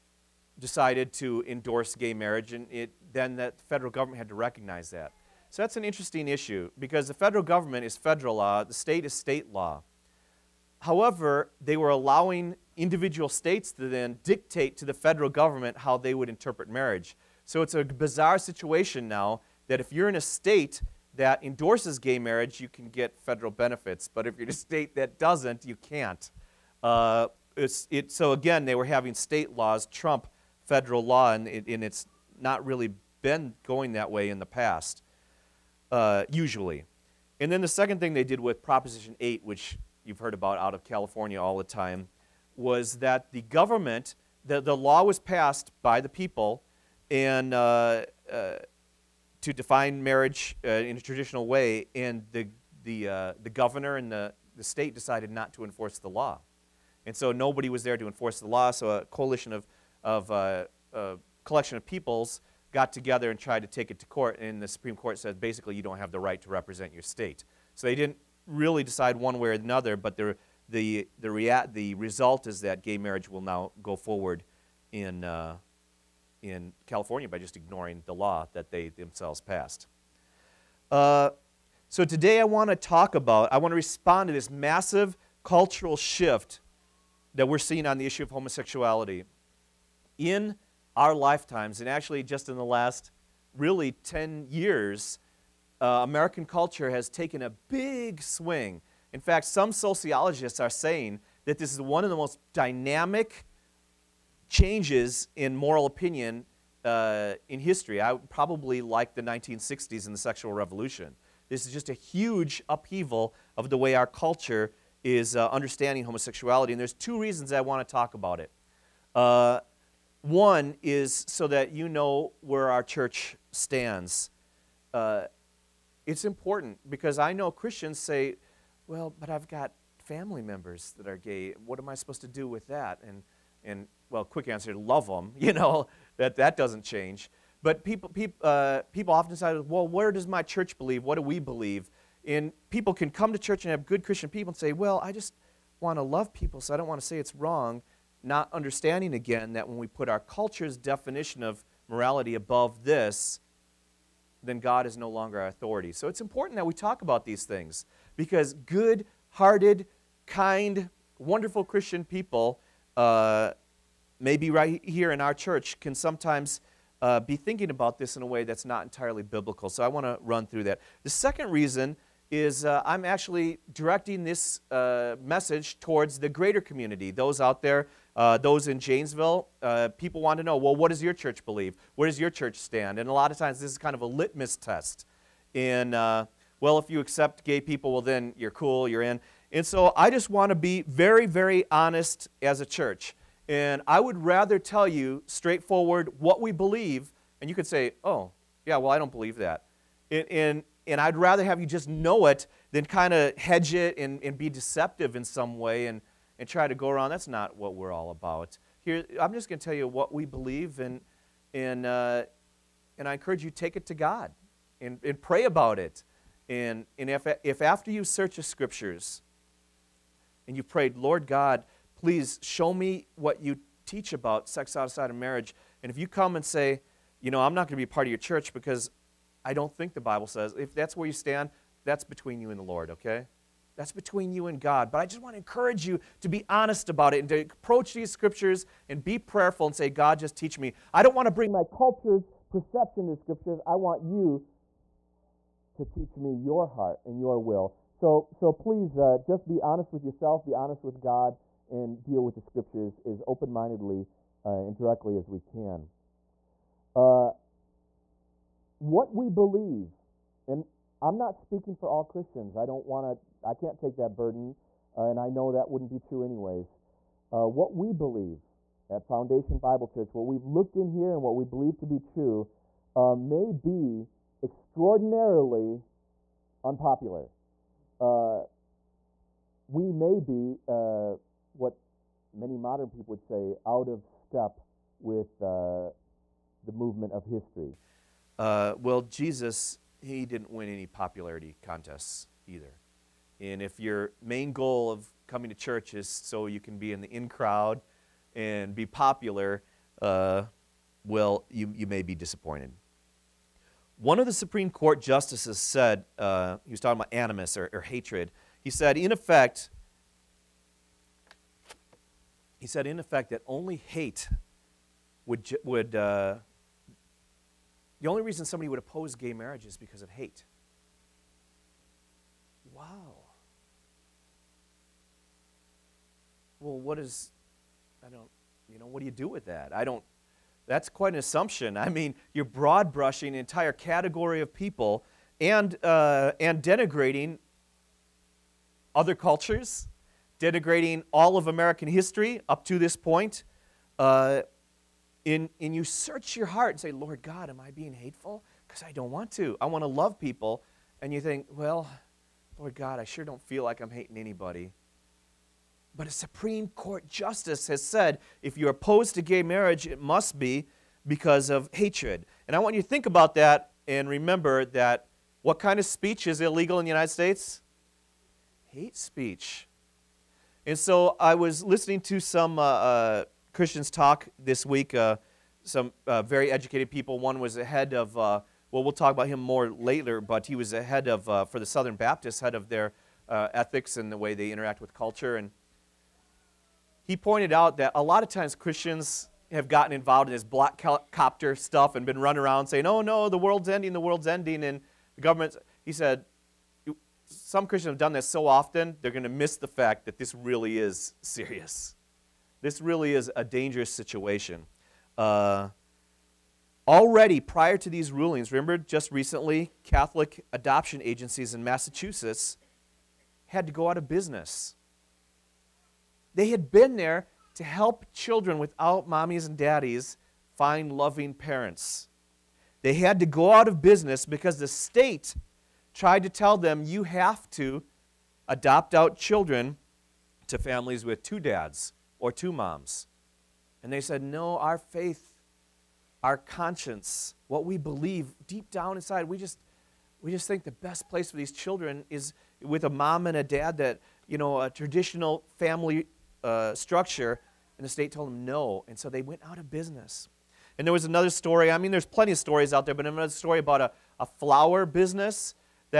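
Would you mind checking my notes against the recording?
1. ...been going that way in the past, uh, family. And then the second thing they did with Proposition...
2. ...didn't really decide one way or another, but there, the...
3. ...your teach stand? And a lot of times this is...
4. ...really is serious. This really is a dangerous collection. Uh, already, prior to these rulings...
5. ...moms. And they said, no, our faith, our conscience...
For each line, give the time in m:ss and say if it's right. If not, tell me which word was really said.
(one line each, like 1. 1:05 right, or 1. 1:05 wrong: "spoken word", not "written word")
1. 0:33 wrong: "usually", not "family"
2. 1:07 right
3. 3:02 wrong: "church", not "teach"
4. 6:40 wrong: "situation", not "collection"
5. 7:12 right.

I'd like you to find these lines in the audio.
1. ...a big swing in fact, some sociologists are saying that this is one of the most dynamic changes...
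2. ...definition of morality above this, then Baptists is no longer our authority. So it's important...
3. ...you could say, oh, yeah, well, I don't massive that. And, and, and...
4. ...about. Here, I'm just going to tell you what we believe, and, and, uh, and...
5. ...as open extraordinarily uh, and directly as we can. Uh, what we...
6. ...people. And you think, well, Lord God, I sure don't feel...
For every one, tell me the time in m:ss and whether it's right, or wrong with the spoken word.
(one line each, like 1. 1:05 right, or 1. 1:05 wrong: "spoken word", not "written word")
1. 1:37 right
2. 2:30 wrong: "God", not "Baptists"
3. 3:17 wrong: "believe", not "massive"
4. 3:28 right
5. 4:13 wrong: "mindedly", not "extraordinarily"
6. 5:50 right.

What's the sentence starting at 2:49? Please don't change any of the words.
So I want to run through that.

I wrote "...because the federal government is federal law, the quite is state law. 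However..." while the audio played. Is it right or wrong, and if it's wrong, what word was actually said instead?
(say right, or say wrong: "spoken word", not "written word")
wrong: "state", not "quite".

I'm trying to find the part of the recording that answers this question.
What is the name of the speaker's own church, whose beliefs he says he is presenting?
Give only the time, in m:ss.
4:29.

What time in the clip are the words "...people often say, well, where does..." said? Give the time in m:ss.
2:18.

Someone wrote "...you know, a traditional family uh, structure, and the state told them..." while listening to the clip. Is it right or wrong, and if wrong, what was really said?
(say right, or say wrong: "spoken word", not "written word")
right.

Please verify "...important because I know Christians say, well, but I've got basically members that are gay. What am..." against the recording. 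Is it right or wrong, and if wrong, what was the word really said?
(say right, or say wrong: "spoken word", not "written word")
wrong: "family", not "basically".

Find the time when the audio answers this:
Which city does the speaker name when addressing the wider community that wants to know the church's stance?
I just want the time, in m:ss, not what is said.
2:58.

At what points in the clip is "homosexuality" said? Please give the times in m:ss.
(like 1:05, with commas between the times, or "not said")
1:28, 1:56.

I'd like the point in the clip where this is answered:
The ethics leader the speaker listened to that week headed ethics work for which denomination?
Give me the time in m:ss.
6:21.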